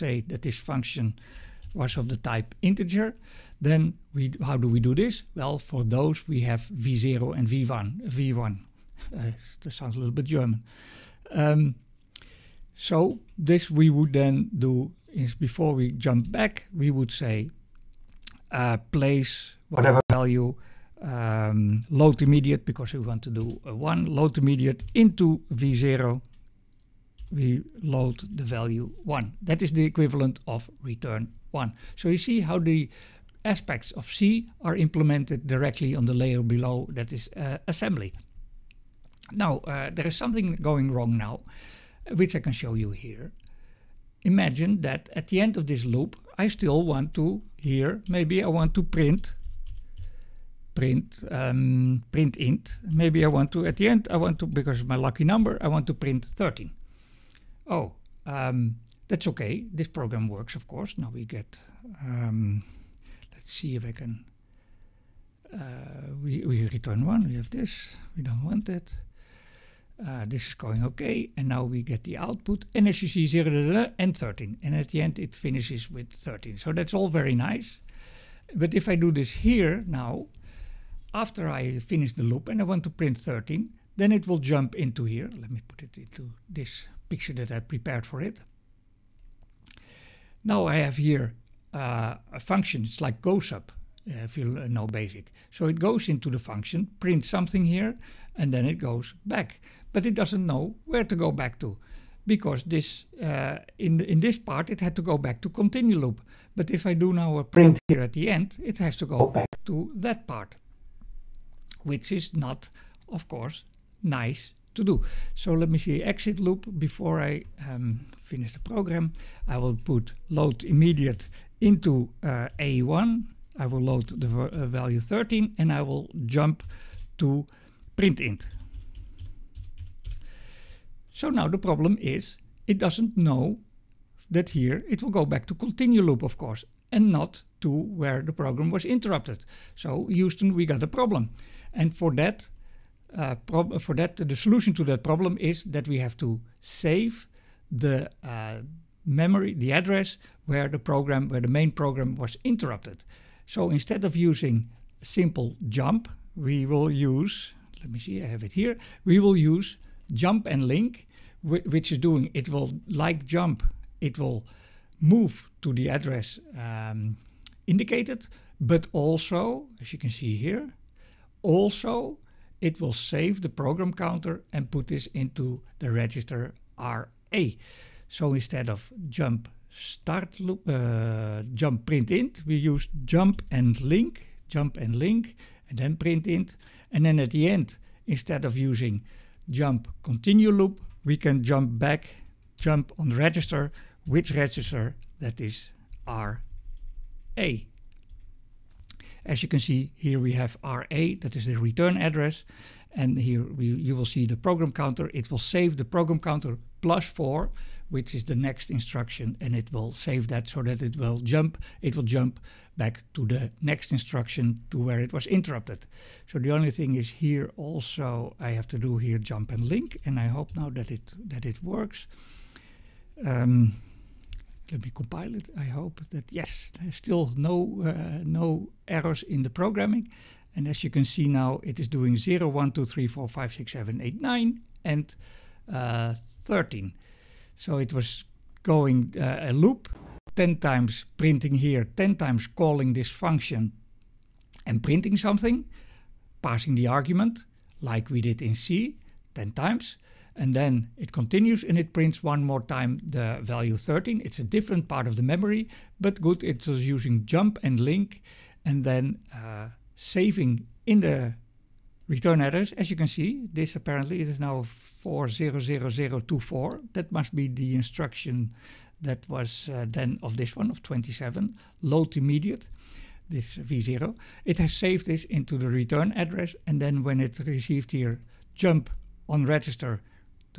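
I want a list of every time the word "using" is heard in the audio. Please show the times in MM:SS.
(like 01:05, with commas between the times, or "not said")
02:34, 03:08, 04:16.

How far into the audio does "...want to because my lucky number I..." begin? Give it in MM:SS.
00:54.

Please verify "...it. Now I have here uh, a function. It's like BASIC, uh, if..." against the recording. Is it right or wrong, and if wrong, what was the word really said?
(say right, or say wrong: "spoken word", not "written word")
wrong: "GOSUB", not "BASIC".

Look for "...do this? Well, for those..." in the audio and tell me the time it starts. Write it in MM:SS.
00:04.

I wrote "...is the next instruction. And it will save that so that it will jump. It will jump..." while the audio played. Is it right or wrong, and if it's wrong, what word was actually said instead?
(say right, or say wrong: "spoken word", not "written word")
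right.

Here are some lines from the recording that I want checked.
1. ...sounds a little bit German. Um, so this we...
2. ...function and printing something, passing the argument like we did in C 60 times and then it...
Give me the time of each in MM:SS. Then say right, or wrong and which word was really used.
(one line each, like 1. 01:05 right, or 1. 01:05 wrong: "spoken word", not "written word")
1. 00:09 right
2. 04:03 wrong: "10", not "60".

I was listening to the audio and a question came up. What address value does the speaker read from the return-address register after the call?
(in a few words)
400024.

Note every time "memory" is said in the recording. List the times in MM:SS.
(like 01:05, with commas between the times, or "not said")
02:29, 04:15.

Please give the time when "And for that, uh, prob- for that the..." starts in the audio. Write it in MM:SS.
02:21.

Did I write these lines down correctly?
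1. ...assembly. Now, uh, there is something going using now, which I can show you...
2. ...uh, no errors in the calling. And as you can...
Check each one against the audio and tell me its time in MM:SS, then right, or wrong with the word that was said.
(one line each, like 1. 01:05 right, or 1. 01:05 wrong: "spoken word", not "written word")
1. 00:37 wrong: "wrong", not "using"
2. 03:47 wrong: "programming", not "calling".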